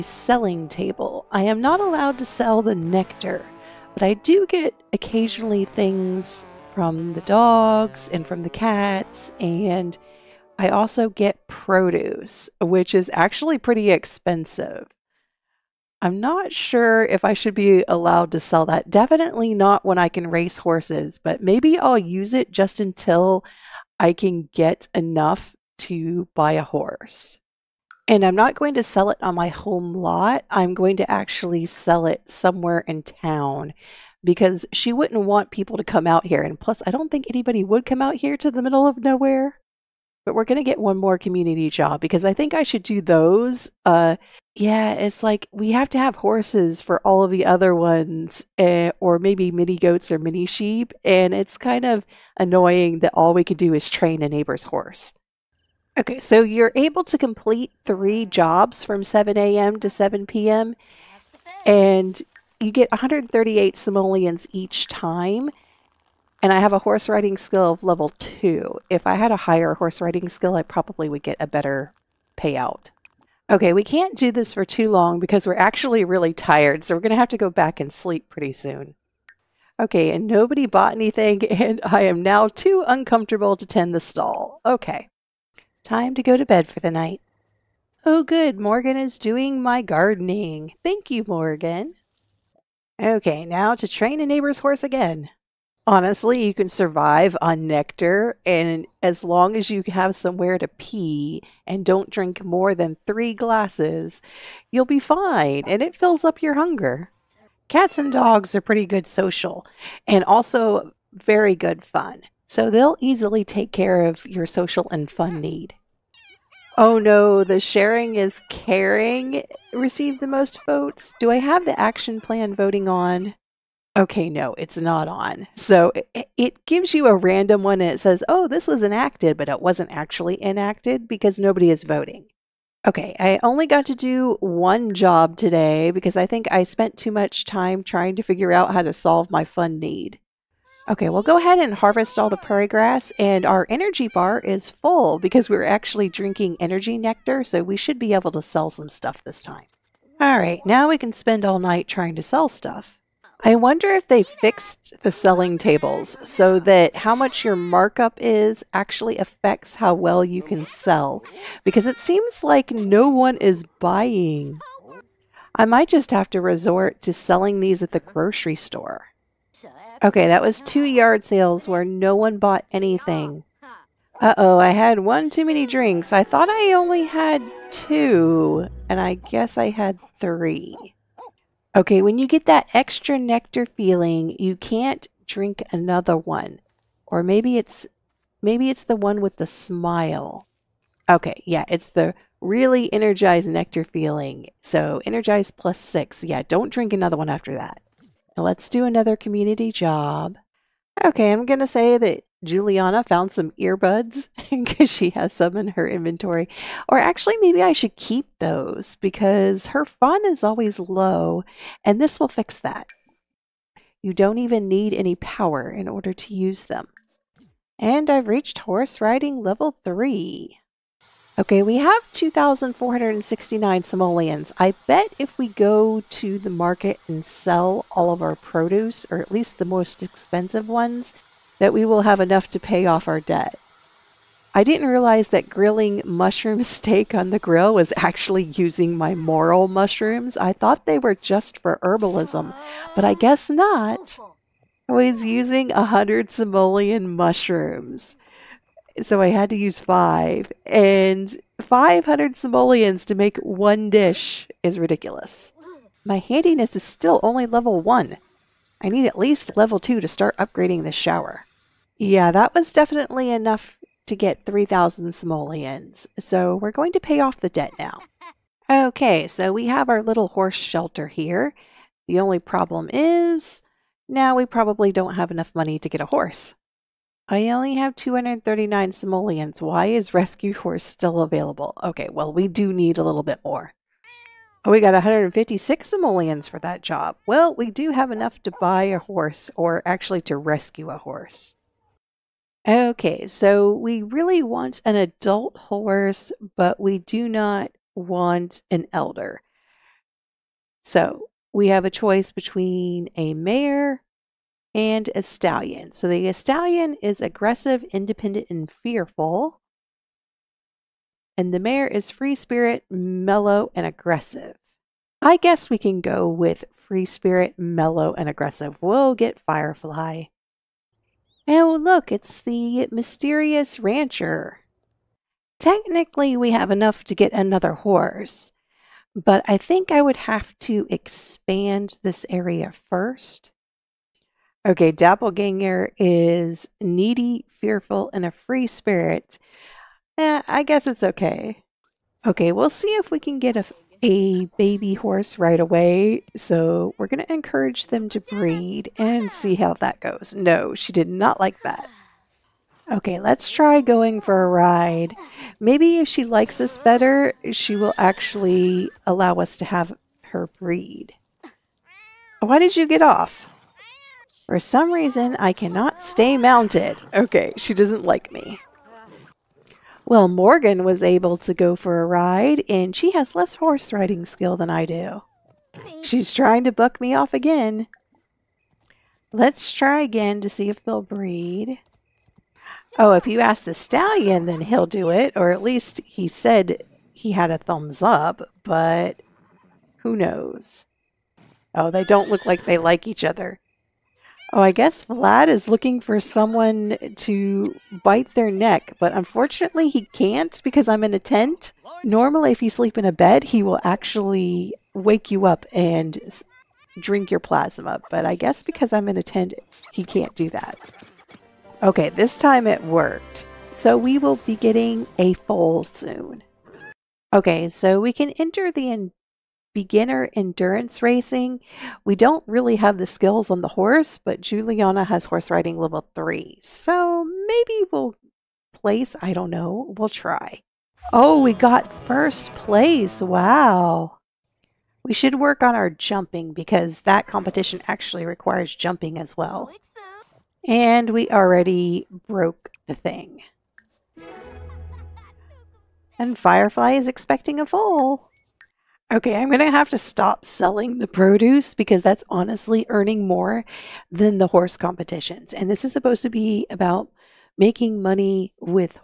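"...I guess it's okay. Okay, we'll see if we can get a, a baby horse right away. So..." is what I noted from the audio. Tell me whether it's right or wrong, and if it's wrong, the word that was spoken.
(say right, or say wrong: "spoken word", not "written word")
right.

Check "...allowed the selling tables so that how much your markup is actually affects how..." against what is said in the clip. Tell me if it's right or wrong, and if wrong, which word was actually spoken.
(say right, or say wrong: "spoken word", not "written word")
wrong: "fixed", not "allowed".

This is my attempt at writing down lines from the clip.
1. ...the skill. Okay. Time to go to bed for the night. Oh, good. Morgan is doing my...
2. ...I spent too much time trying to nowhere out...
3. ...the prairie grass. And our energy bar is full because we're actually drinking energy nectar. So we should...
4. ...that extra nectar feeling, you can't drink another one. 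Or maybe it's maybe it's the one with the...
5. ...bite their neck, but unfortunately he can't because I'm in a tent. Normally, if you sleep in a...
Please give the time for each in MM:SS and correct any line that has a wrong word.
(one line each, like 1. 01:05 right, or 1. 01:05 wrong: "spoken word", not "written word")
1. 01:23 wrong: "stall", not "skill"
2. 02:16 wrong: "figure", not "nowhere"
3. 02:22 right
4. 03:02 right
5. 06:38 right.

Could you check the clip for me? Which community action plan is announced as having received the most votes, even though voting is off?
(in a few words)
Sharing is caring.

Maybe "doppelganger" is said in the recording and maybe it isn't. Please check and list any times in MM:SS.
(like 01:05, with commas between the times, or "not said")
05:34.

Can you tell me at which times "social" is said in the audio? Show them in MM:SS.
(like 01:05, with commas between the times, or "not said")
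01:49, 01:54.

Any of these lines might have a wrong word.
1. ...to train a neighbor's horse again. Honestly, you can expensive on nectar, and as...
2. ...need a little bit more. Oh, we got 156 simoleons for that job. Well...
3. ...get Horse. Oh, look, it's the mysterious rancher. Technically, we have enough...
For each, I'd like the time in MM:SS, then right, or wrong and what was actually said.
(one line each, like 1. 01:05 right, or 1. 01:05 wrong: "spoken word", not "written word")
1. 01:33 wrong: "survive", not "expensive"
2. 04:42 right
3. 05:19 wrong: "Firefly", not "Horse".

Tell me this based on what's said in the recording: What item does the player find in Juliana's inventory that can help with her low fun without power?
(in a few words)
Earbuds.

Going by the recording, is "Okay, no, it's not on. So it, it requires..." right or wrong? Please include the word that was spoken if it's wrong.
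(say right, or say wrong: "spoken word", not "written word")
wrong: "gives", not "requires".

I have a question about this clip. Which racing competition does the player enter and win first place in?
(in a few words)
Beginner endurance racing.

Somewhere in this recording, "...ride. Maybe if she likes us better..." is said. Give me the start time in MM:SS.
05:54.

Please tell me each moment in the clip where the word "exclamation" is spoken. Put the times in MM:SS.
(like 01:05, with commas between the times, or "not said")
not said.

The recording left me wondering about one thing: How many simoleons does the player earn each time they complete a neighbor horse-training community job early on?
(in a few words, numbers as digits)
138.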